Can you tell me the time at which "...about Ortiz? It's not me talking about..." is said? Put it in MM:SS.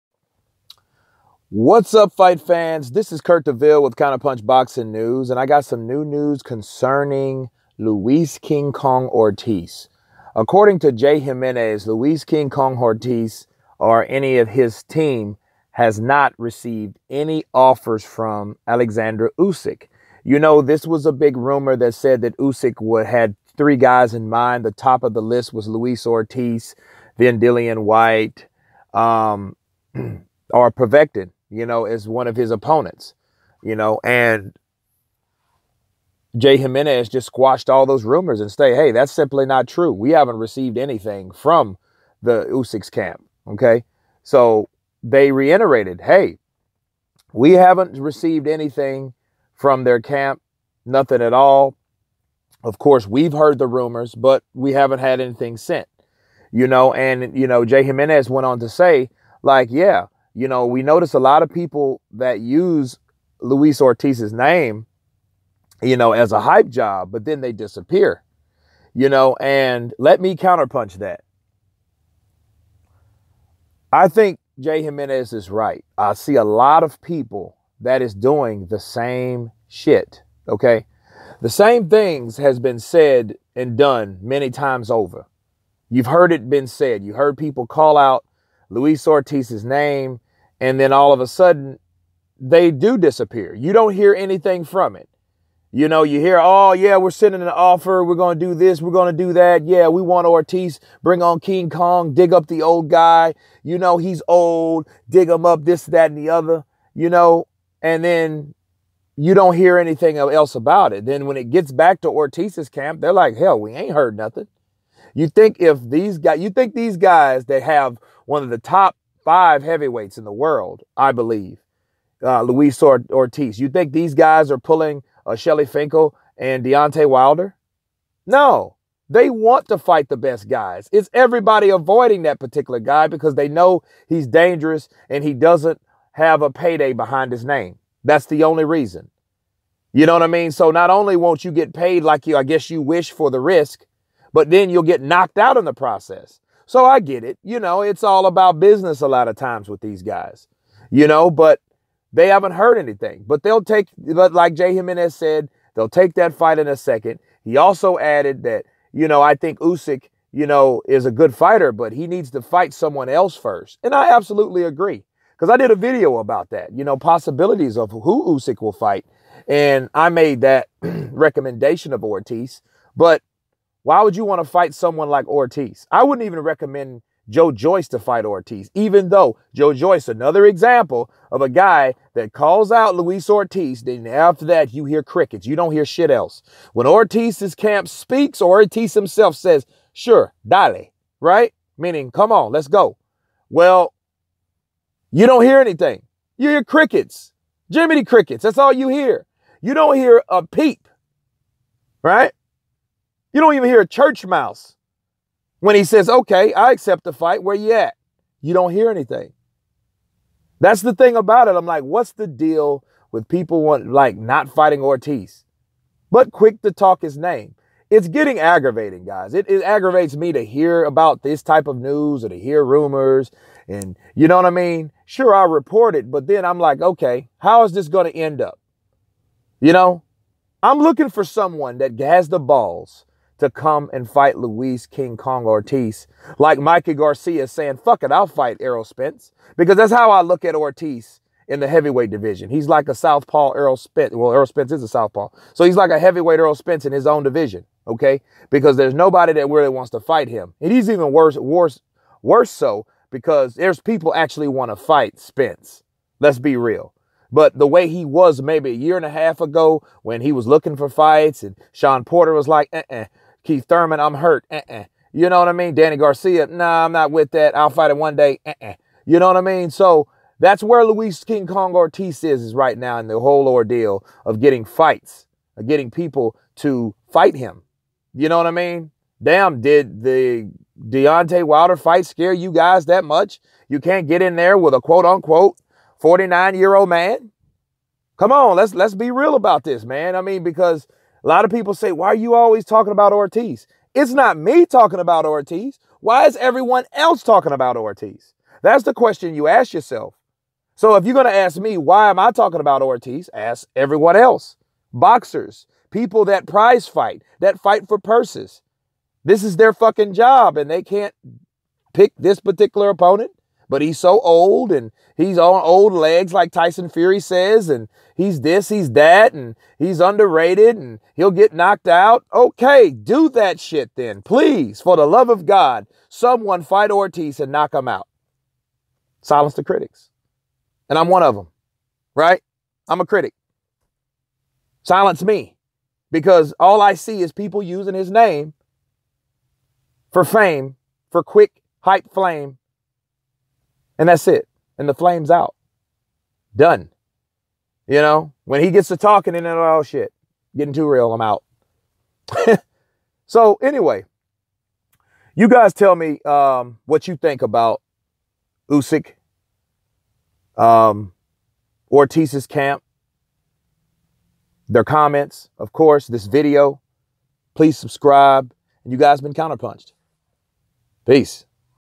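04:52.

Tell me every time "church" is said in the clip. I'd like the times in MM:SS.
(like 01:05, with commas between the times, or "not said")
03:23.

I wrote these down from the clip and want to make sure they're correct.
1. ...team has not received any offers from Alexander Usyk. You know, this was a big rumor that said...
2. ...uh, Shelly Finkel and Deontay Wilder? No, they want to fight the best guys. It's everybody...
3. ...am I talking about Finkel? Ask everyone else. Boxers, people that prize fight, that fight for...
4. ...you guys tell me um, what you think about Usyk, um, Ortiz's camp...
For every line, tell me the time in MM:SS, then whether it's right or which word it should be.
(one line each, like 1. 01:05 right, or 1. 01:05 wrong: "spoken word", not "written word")
1. 00:14 right
2. 02:05 right
3. 05:02 wrong: "Ortiz", not "Finkel"
4. 05:55 right.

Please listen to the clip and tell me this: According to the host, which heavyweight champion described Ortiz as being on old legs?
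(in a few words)
Tyson Fury.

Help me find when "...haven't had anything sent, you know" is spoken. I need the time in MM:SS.
00:54.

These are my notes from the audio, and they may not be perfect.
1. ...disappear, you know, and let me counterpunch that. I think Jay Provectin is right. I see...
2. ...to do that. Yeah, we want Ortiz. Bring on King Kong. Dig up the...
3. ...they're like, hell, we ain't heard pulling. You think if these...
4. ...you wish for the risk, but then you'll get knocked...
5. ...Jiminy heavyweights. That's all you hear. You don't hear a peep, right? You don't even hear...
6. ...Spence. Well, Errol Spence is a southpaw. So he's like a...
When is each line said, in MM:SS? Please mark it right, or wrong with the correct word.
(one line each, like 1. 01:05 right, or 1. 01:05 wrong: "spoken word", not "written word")
1. 01:07 wrong: "Jimenez", not "Provectin"
2. 01:39 right
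3. 01:52 wrong: "nothing", not "pulling"
4. 02:22 right
5. 03:17 wrong: "crickets", not "heavyweights"
6. 04:03 right.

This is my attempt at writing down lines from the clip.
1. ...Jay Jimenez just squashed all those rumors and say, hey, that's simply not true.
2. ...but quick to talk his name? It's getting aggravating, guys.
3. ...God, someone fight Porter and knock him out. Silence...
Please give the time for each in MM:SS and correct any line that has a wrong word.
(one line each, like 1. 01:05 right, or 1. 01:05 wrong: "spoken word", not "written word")
1. 00:36 right
2. 03:36 right
3. 05:25 wrong: "Ortiz", not "Porter".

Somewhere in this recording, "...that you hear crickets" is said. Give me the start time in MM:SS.
03:04.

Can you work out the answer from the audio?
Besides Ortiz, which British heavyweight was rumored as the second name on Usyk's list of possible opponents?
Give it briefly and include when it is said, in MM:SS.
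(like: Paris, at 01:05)
Dillian White, at 00:27.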